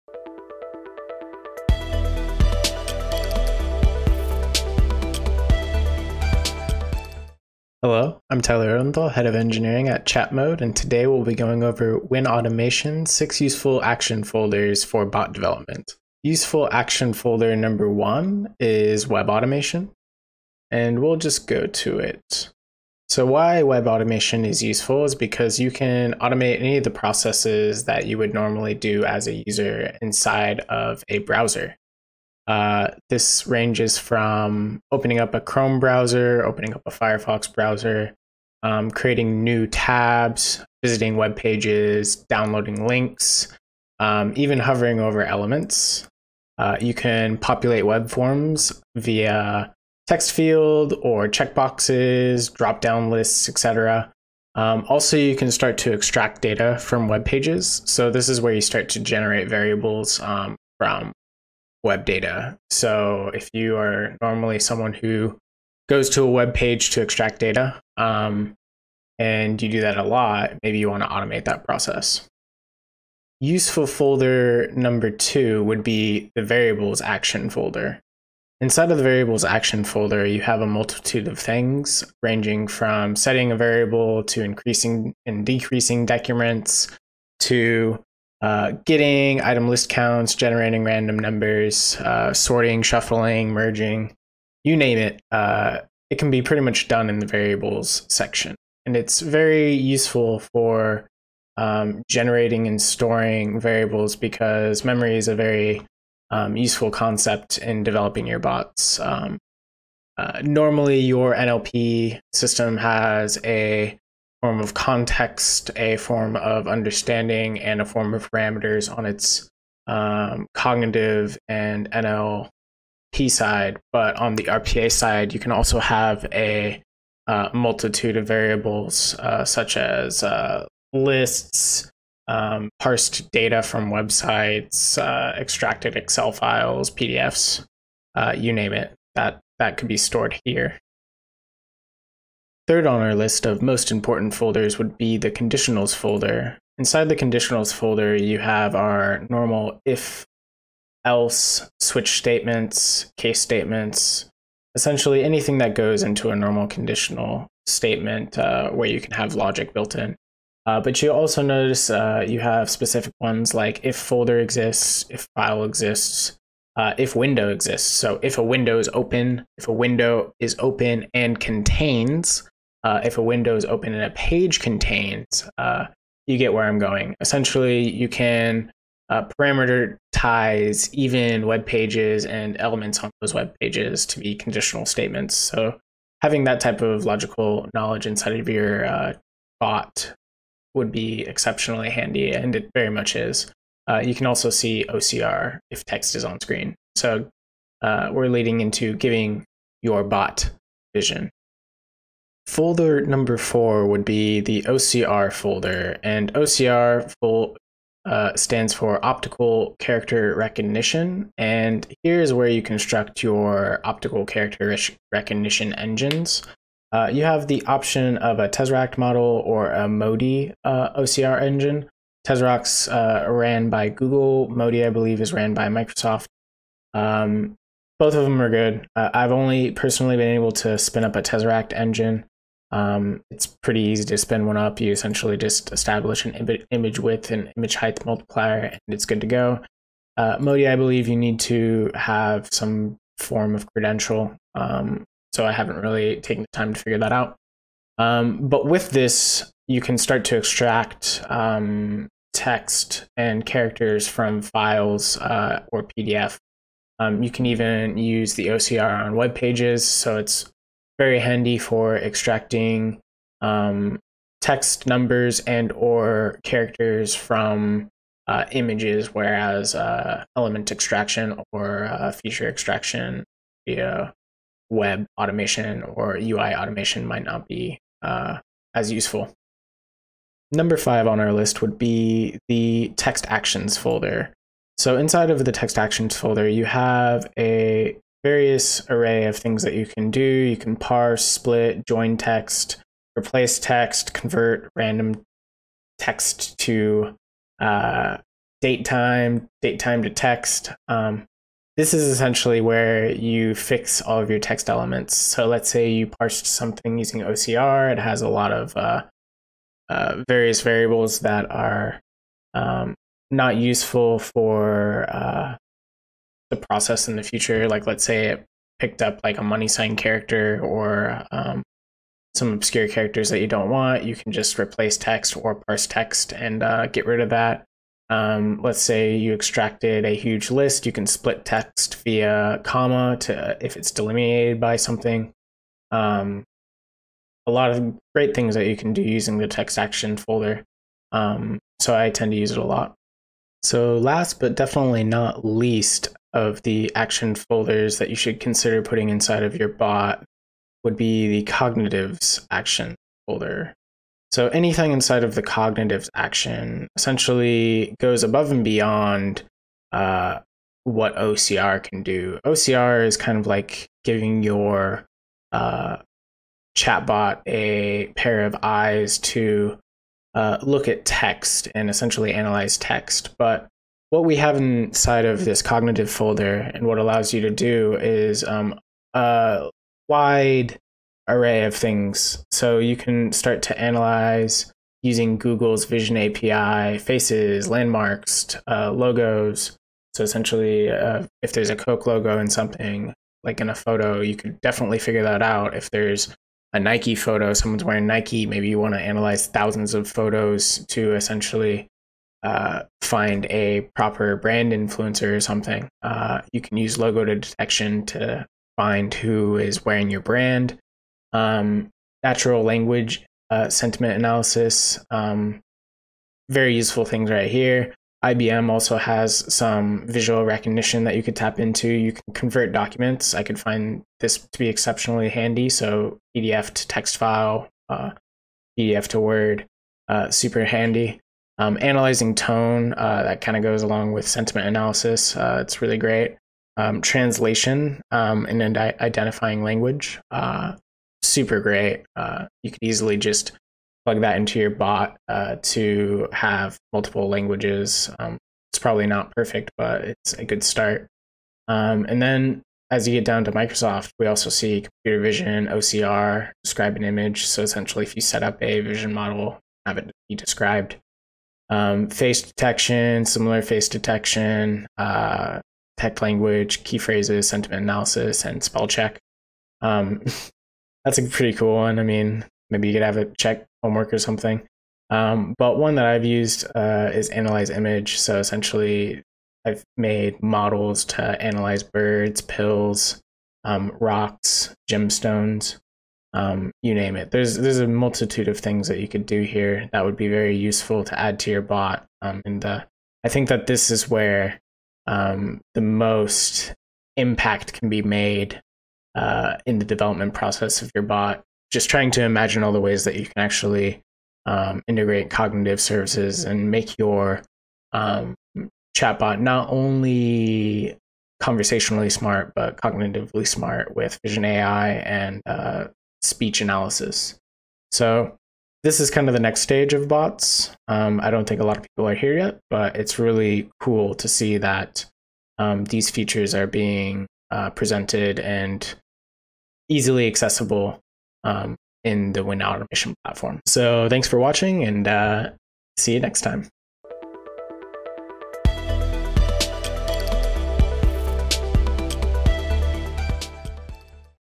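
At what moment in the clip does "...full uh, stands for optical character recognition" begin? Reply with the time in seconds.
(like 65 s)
207 s.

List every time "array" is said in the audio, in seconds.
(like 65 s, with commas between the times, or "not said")
288 s, 381 s.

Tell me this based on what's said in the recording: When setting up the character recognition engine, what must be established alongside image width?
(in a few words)
Image height.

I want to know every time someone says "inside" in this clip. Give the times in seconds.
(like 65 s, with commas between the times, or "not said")
30 s, 78 s, 146 s, 188 s, 284 s, 349 s, 354 s, 374 s.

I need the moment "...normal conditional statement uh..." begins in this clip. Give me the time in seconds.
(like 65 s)
156 s.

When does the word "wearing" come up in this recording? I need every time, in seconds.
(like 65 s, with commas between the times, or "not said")
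397 s, 409 s.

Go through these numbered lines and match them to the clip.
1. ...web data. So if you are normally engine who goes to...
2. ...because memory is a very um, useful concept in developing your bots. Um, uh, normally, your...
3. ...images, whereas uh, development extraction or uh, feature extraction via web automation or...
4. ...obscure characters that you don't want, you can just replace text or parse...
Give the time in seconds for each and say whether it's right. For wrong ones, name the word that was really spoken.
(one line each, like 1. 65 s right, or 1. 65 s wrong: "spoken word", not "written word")
1. 61 s wrong: "someone", not "engine"
2. 104 s right
3. 268 s wrong: "element", not "development"
4. 322 s right.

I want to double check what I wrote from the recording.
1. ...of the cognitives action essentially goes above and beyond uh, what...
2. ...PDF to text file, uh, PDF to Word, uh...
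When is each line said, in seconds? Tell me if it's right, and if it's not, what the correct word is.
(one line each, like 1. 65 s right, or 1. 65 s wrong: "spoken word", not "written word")
1. 355 s right
2. 426 s right.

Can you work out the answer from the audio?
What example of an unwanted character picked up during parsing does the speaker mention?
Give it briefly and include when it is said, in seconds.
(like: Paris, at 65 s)
Money sign, at 319 s.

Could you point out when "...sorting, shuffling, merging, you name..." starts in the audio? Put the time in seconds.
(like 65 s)
92 s.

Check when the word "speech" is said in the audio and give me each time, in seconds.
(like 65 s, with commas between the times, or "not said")
516 s.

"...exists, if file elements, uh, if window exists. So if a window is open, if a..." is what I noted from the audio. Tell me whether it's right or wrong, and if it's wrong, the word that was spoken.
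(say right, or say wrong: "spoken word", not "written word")
wrong: "exists", not "elements".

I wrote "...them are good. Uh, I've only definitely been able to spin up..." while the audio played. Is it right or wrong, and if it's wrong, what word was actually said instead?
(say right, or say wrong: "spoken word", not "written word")
wrong: "personally", not "definitely".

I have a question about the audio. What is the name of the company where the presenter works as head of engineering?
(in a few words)
Chatmode.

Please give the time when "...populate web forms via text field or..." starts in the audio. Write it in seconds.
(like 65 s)
47 s.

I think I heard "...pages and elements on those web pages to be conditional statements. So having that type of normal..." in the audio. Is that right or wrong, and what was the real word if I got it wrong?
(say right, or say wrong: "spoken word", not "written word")
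wrong: "logical", not "normal".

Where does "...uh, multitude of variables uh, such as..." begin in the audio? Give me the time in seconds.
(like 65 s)
127 s.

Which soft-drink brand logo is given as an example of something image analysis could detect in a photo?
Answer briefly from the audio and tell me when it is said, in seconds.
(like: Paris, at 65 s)
Coke, at 391 s.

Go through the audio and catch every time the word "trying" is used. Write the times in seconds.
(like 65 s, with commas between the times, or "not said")
501 s.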